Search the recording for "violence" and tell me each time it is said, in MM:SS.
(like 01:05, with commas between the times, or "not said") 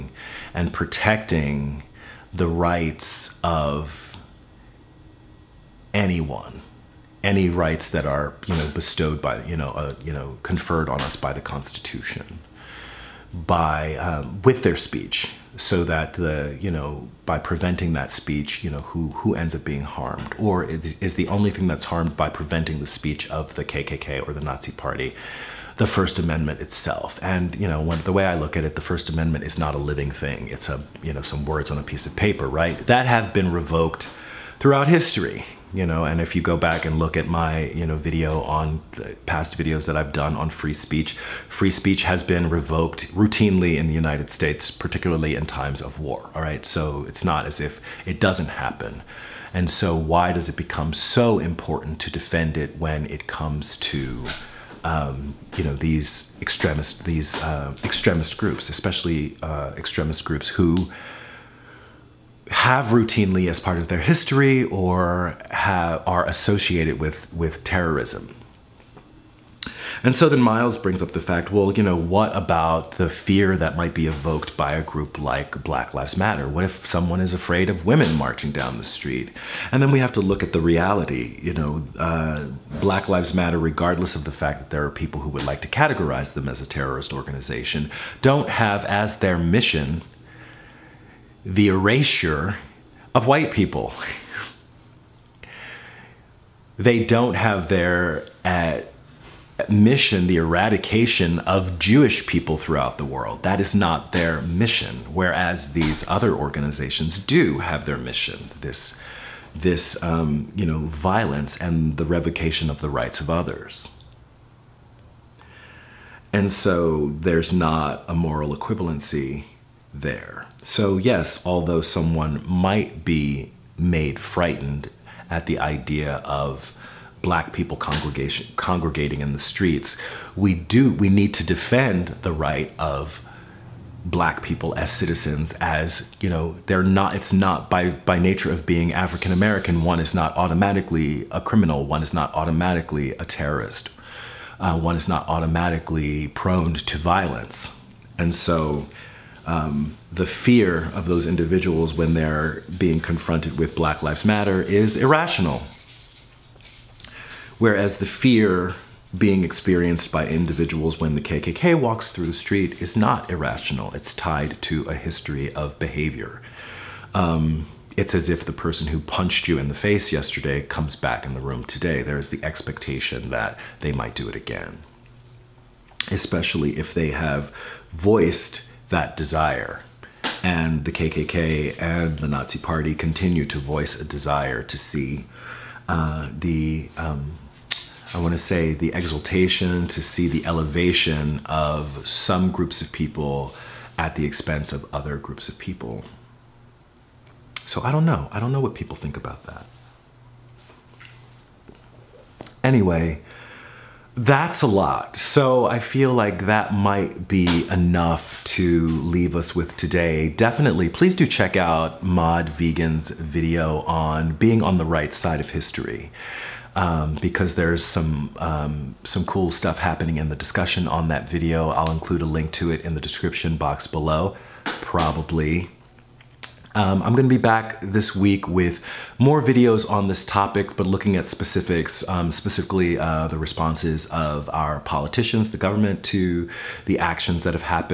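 01:50, 02:26.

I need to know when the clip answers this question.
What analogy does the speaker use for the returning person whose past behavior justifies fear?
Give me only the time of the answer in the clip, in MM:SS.
02:48.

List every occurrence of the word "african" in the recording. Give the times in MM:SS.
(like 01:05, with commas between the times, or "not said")
02:18.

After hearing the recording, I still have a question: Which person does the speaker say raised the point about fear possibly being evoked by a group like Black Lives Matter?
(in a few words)
Miles.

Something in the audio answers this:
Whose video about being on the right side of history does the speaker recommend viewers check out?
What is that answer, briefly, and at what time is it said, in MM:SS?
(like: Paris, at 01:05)
Mod Vegan, at 03:32.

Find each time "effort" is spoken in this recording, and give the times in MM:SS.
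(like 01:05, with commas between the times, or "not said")
not said.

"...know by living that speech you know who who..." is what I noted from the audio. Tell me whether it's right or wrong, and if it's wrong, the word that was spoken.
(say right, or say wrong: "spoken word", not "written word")
wrong: "preventing", not "living".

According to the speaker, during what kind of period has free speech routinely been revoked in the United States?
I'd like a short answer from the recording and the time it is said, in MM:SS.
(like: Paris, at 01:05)
Times of war, at 00:45.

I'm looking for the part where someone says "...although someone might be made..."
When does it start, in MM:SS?
02:01.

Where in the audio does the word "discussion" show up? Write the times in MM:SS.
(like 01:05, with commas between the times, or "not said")
03:40.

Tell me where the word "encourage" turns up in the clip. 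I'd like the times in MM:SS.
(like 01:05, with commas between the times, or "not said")
not said.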